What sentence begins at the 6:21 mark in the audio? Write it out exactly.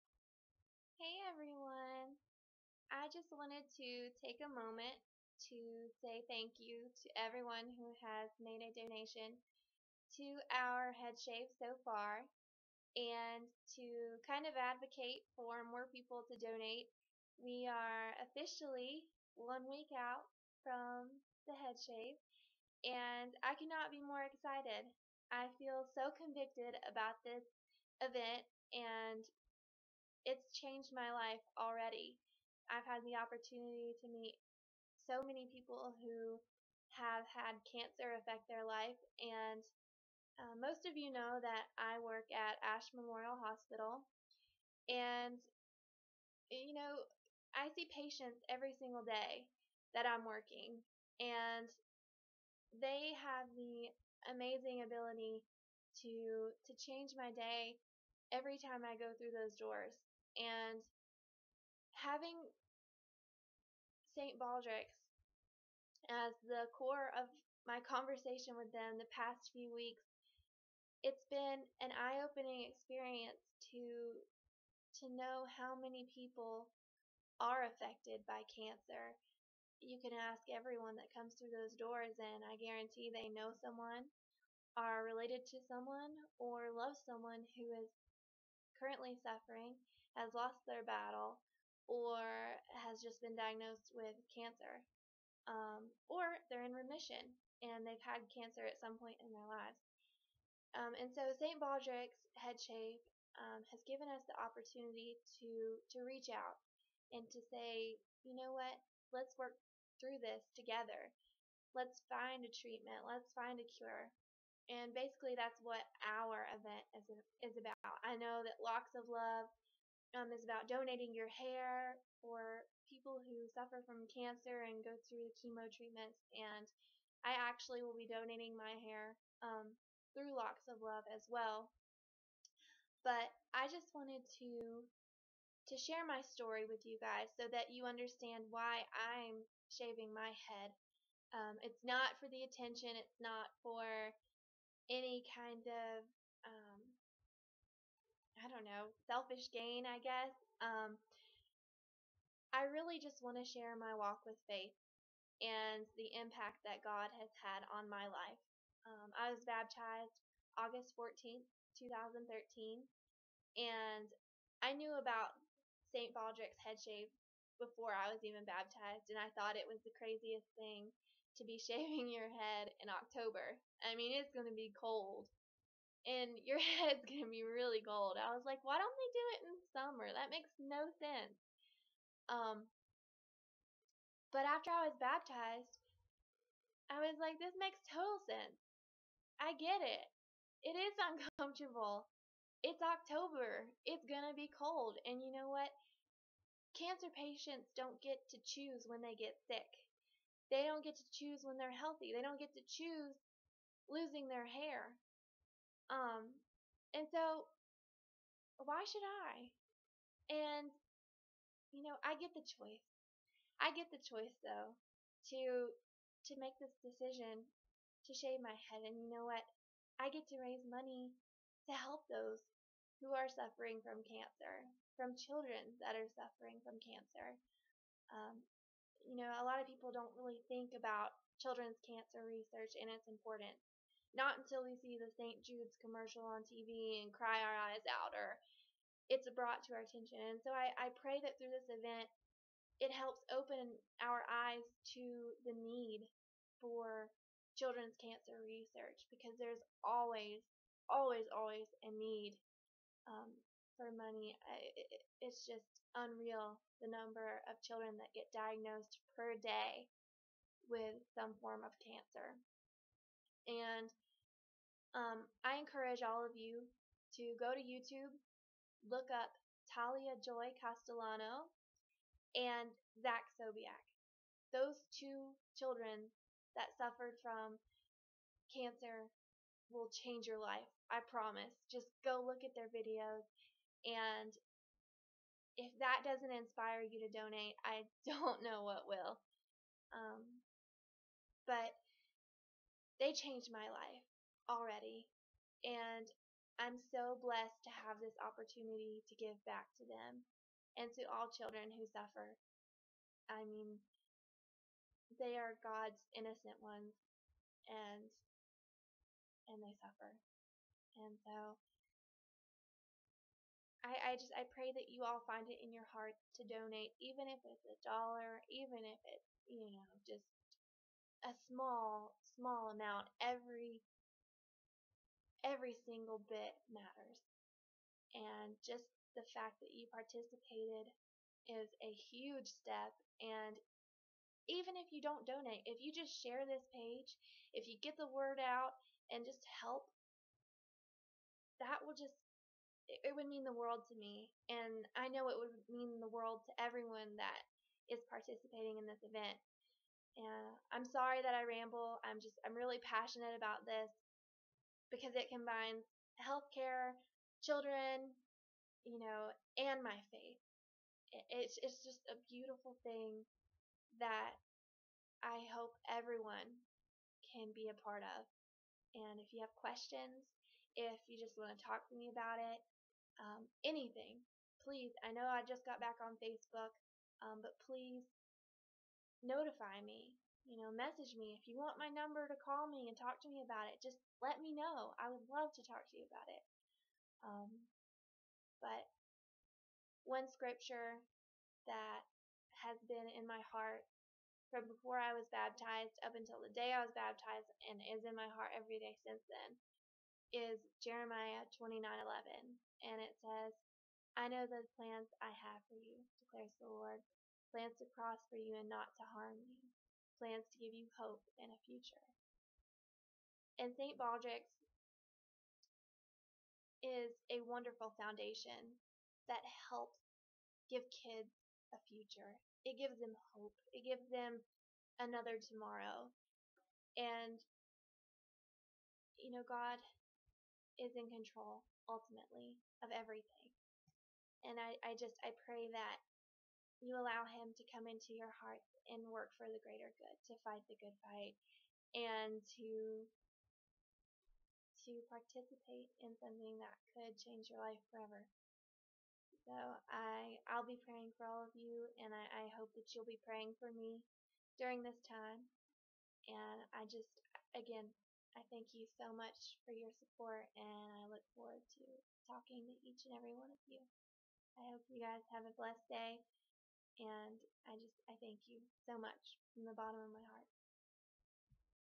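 If you want my number to call me and talk to me about it, just let me know.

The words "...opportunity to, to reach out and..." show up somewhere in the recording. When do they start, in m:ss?
1:44.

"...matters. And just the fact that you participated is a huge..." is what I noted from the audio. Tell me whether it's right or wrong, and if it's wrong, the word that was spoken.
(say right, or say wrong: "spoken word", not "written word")
right.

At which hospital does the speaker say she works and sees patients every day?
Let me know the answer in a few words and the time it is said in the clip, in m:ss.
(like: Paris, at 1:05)
Ashe Memorial Hospital, at 0:42.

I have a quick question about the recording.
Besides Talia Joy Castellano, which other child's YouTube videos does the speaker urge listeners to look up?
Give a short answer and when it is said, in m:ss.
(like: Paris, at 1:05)
Zach Sobiech, at 4:32.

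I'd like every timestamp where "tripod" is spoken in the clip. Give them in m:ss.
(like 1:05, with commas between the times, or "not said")
not said.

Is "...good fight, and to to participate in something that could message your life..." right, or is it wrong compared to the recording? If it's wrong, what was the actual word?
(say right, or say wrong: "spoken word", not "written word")
wrong: "change", not "message".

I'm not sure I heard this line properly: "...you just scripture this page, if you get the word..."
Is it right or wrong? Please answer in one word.
wrong.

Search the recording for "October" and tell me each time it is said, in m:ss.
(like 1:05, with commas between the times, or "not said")
2:52, 3:12.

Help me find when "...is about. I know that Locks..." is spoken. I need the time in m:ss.
1:57.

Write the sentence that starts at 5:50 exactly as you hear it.
And I'm sorry that I ramble.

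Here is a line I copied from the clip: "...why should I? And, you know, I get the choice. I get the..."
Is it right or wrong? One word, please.
right.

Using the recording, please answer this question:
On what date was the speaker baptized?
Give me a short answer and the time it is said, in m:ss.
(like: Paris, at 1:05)
August 14th, 2013, at 2:40.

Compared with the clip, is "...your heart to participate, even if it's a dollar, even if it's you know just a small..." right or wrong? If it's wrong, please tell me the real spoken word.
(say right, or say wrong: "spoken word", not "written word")
wrong: "donate", not "participate".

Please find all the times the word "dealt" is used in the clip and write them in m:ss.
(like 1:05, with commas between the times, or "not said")
not said.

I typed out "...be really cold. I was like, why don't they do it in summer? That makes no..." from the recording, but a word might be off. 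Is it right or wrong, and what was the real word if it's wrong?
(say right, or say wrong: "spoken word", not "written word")
right.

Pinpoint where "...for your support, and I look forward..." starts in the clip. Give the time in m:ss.
7:39.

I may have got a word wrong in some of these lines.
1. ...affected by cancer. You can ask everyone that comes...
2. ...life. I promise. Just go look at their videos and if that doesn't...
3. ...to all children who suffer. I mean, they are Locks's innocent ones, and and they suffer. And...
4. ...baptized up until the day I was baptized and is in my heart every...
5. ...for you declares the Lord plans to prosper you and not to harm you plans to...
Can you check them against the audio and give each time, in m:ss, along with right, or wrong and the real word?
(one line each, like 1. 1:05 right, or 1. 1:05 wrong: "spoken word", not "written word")
1. 1:17 right
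2. 4:40 right
3. 5:00 wrong: "God", not "Locks"
4. 6:35 right
5. 6:45 right.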